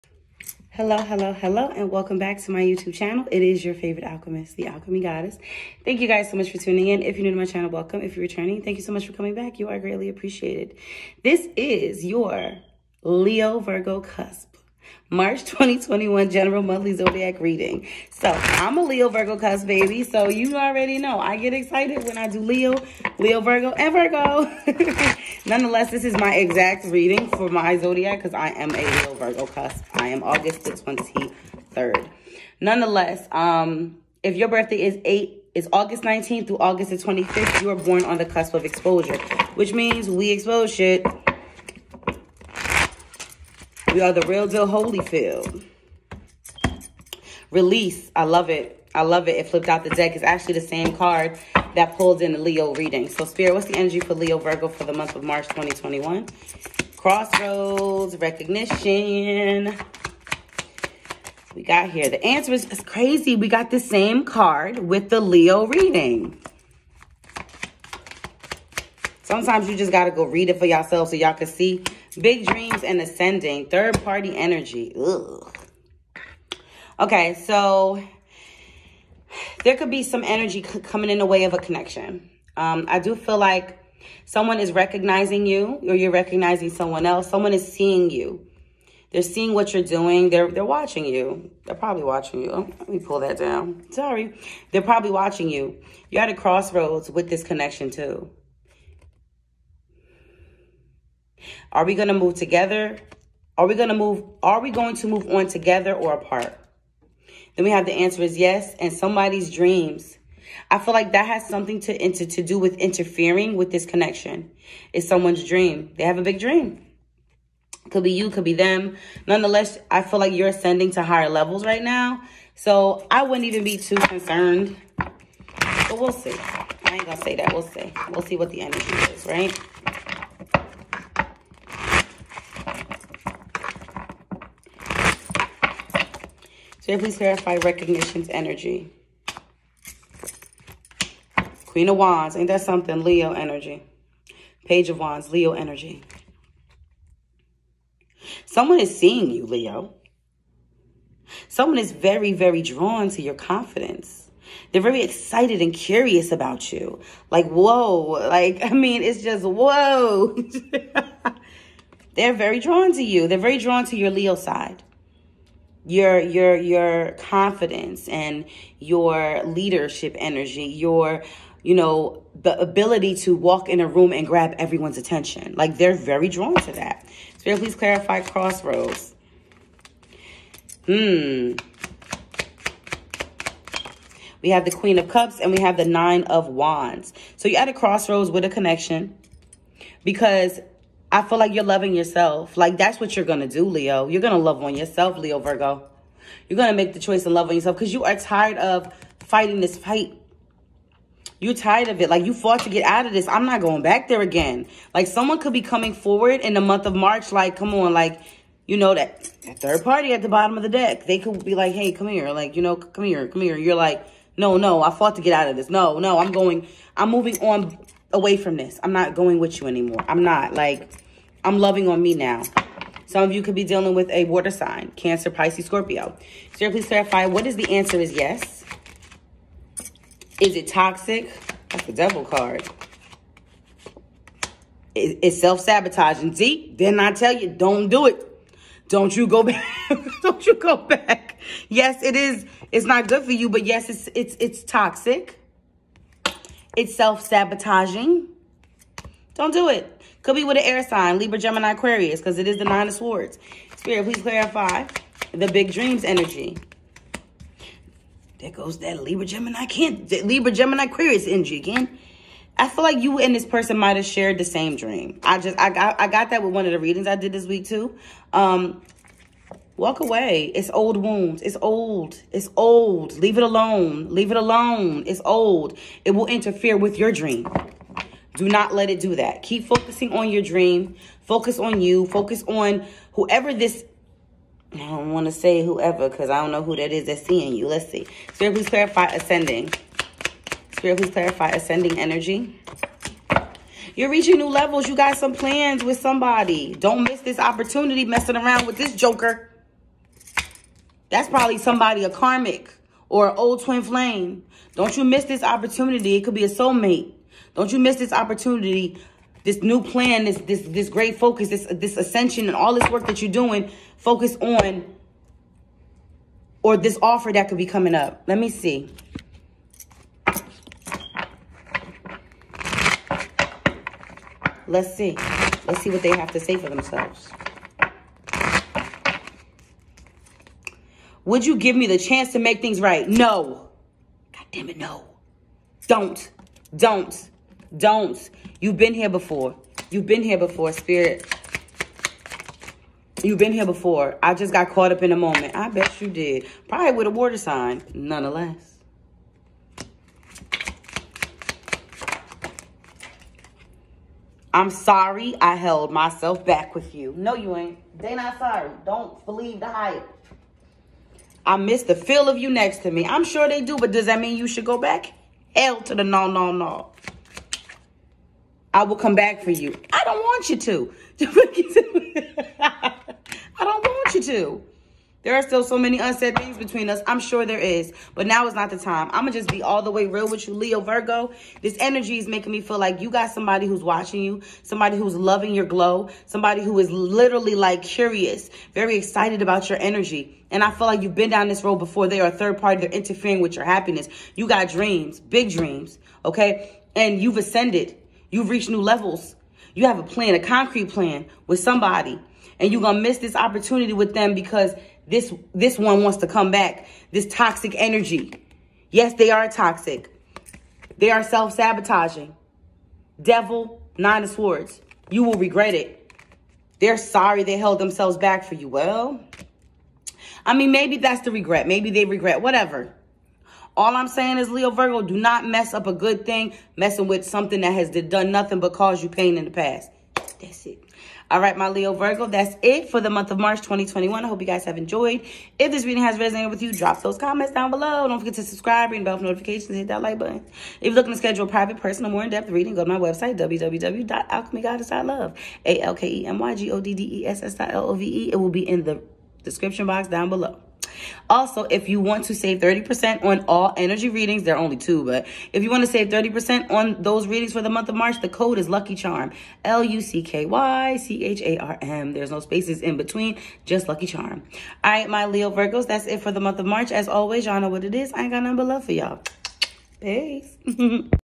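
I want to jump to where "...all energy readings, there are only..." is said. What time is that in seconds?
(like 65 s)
453 s.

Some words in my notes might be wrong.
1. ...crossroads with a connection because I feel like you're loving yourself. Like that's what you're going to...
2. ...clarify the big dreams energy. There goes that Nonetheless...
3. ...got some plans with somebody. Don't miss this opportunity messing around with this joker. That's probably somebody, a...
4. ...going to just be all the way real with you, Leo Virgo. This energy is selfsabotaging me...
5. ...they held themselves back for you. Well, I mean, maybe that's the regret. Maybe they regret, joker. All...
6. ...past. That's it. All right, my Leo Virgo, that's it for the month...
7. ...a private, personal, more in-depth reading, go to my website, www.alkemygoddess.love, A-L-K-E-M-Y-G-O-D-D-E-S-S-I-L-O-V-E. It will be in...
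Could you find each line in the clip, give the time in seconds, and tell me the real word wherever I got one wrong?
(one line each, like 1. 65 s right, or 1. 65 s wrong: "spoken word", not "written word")
1. 187 s right
2. 254 s wrong: "Libra", not "Nonetheless"
3. 294 s right
4. 379 s wrong: "making", not "selfsabotaging"
5. 417 s wrong: "whatever", not "joker"
6. 429 s right
7. 441 s right.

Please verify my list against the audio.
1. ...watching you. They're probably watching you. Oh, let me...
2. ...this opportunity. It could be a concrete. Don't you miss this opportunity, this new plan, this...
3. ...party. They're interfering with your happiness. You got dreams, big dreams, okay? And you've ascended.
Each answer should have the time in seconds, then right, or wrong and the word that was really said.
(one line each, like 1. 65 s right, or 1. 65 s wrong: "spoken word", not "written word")
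1. 90 s right
2. 305 s wrong: "soulmate", not "concrete"
3. 392 s right.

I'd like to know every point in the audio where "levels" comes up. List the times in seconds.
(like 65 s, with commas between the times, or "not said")
121 s, 294 s, 398 s.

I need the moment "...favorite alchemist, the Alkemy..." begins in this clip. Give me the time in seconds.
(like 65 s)
3 s.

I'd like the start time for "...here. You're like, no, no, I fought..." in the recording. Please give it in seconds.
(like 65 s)
213 s.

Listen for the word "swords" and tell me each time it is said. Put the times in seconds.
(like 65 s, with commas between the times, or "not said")
252 s, 414 s.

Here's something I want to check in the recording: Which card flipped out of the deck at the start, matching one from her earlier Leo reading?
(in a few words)
Release.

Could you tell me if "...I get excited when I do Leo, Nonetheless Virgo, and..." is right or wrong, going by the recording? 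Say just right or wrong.
wrong.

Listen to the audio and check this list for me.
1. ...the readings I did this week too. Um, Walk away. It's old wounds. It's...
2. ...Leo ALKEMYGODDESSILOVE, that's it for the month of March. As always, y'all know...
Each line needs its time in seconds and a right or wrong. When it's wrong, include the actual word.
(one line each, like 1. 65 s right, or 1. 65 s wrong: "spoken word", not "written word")
1. 266 s right
2. 465 s wrong: "Virgos", not "ALKEMYGODDESSILOVE".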